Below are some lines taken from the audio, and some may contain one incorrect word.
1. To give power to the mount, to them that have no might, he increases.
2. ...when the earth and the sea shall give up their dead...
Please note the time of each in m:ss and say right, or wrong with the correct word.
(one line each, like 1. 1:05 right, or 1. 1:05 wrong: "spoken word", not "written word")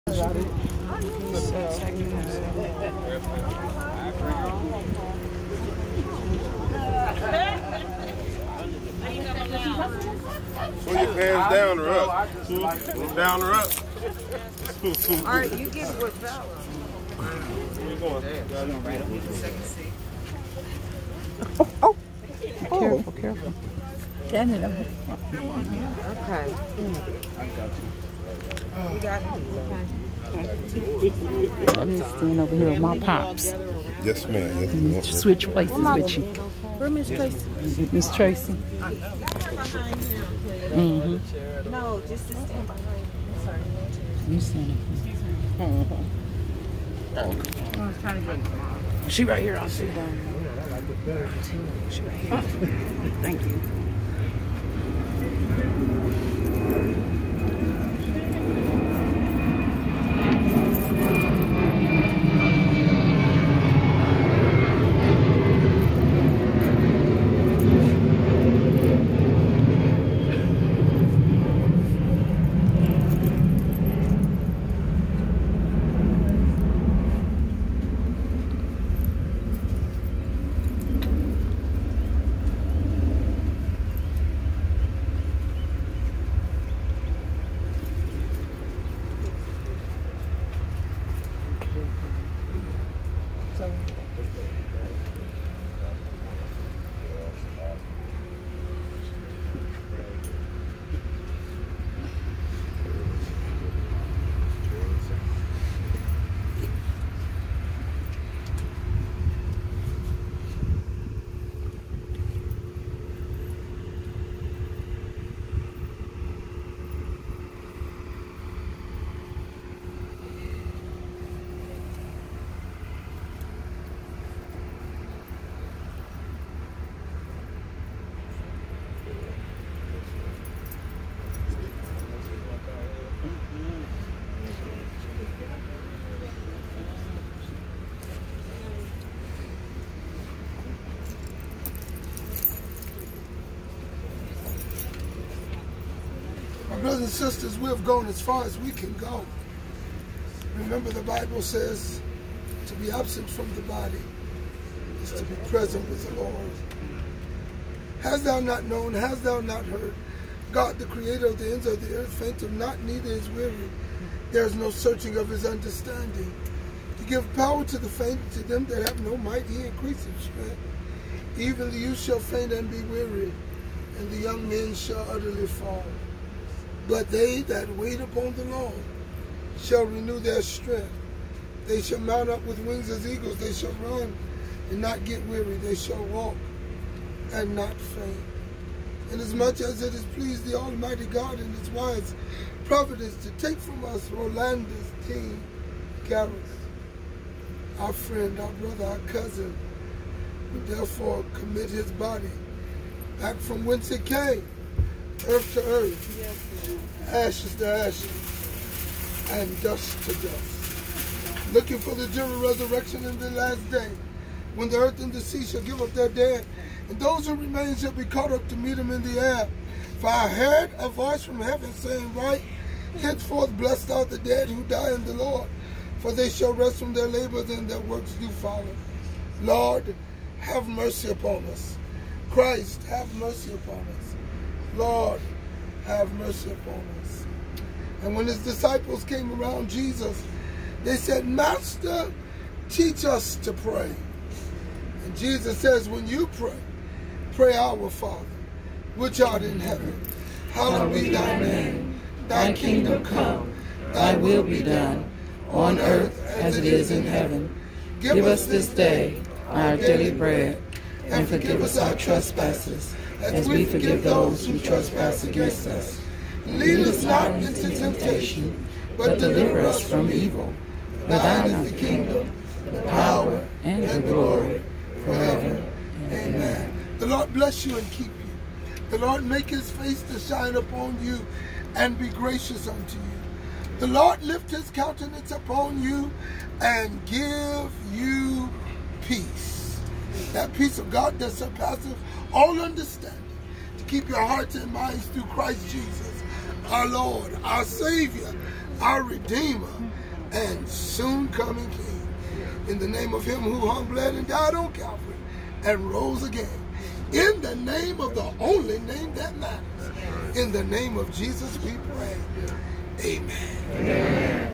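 1. 2:46 wrong: "faint", not "mount"
2. 3:34 right.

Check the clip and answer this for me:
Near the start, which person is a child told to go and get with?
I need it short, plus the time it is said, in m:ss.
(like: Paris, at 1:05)
Bella, at 0:16.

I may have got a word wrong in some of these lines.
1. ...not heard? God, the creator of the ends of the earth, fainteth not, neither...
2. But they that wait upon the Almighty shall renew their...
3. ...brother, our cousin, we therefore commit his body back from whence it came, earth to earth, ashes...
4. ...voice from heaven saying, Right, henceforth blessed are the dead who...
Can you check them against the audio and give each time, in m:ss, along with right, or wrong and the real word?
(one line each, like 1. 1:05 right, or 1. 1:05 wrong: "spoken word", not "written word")
1. 2:39 right
2. 2:56 wrong: "Lord", not "Almighty"
3. 3:18 right
4. 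3:40 right.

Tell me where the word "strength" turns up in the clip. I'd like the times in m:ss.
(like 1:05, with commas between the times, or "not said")
2:50, 3:00.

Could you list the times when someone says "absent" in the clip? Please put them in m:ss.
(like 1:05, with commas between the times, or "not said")
2:32.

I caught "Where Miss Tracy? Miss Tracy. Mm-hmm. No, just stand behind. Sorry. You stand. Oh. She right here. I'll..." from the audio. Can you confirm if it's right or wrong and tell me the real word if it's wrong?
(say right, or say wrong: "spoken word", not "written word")
right.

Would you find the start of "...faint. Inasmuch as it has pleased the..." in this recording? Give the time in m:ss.
3:07.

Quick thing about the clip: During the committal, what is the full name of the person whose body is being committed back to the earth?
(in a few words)
Rolandus T. Gareth.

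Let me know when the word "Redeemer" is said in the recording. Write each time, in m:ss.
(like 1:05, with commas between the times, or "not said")
4:59.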